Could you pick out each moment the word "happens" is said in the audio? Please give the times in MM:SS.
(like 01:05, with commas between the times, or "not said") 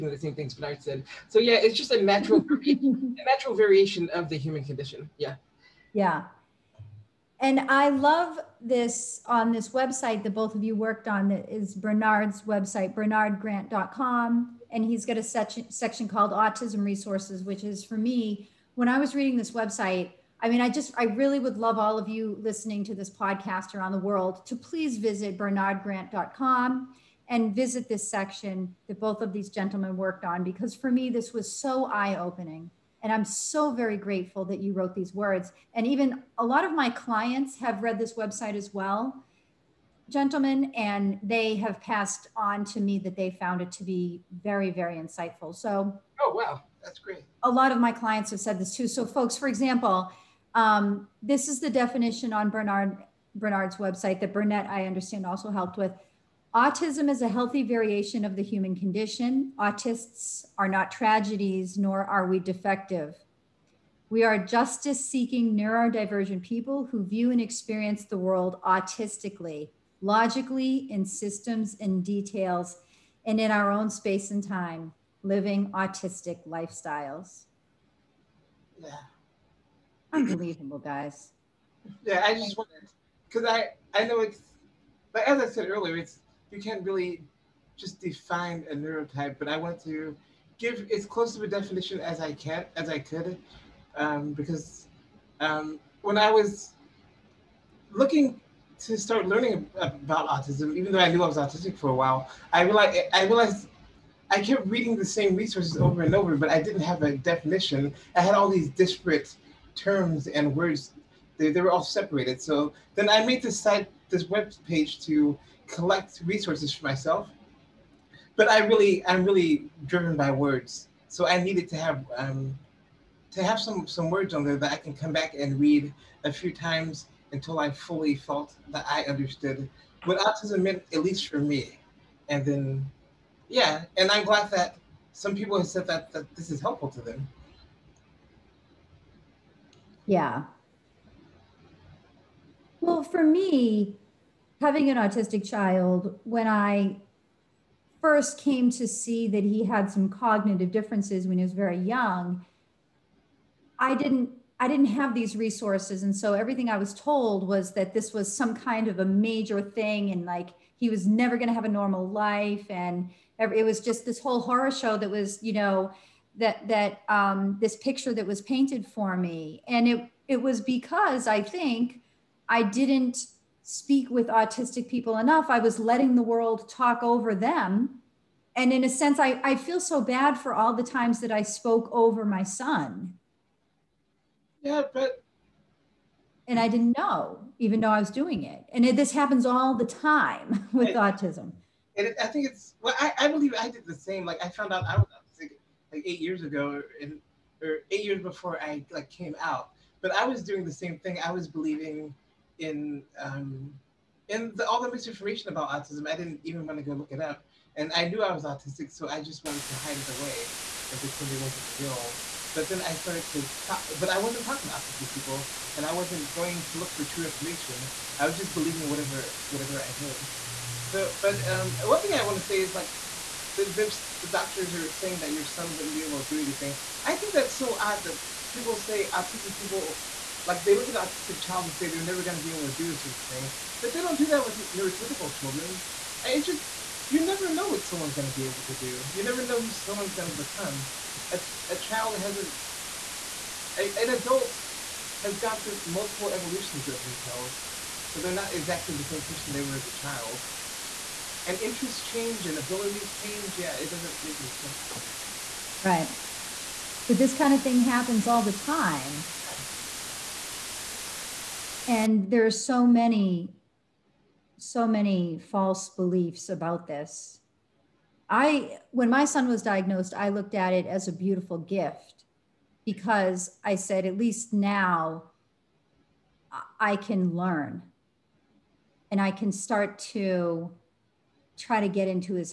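03:09, 04:17.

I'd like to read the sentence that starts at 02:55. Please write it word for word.
I was letting the world talk over them.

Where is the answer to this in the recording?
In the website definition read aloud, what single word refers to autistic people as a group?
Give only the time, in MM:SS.
00:59.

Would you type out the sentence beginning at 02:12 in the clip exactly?
And then, yeah, and I'm glad that some people have said that, that this is helpful to them.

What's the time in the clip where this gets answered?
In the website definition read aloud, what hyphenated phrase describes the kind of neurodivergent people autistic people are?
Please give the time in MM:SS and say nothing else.
01:04.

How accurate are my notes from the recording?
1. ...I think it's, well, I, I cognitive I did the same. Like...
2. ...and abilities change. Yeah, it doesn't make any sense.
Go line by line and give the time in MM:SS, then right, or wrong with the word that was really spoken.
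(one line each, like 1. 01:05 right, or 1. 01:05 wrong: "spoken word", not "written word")
1. 03:12 wrong: "believe", not "cognitive"
2. 04:12 right.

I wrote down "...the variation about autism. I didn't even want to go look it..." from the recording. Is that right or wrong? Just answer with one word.
wrong.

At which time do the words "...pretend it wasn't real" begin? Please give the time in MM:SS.
03:30.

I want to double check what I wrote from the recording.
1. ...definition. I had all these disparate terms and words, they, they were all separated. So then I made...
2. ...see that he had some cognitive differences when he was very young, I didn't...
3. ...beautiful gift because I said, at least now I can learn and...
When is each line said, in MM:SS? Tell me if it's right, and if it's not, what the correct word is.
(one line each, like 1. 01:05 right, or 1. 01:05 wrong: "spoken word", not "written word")
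1. 01:47 right
2. 02:28 right
3. 04:31 right.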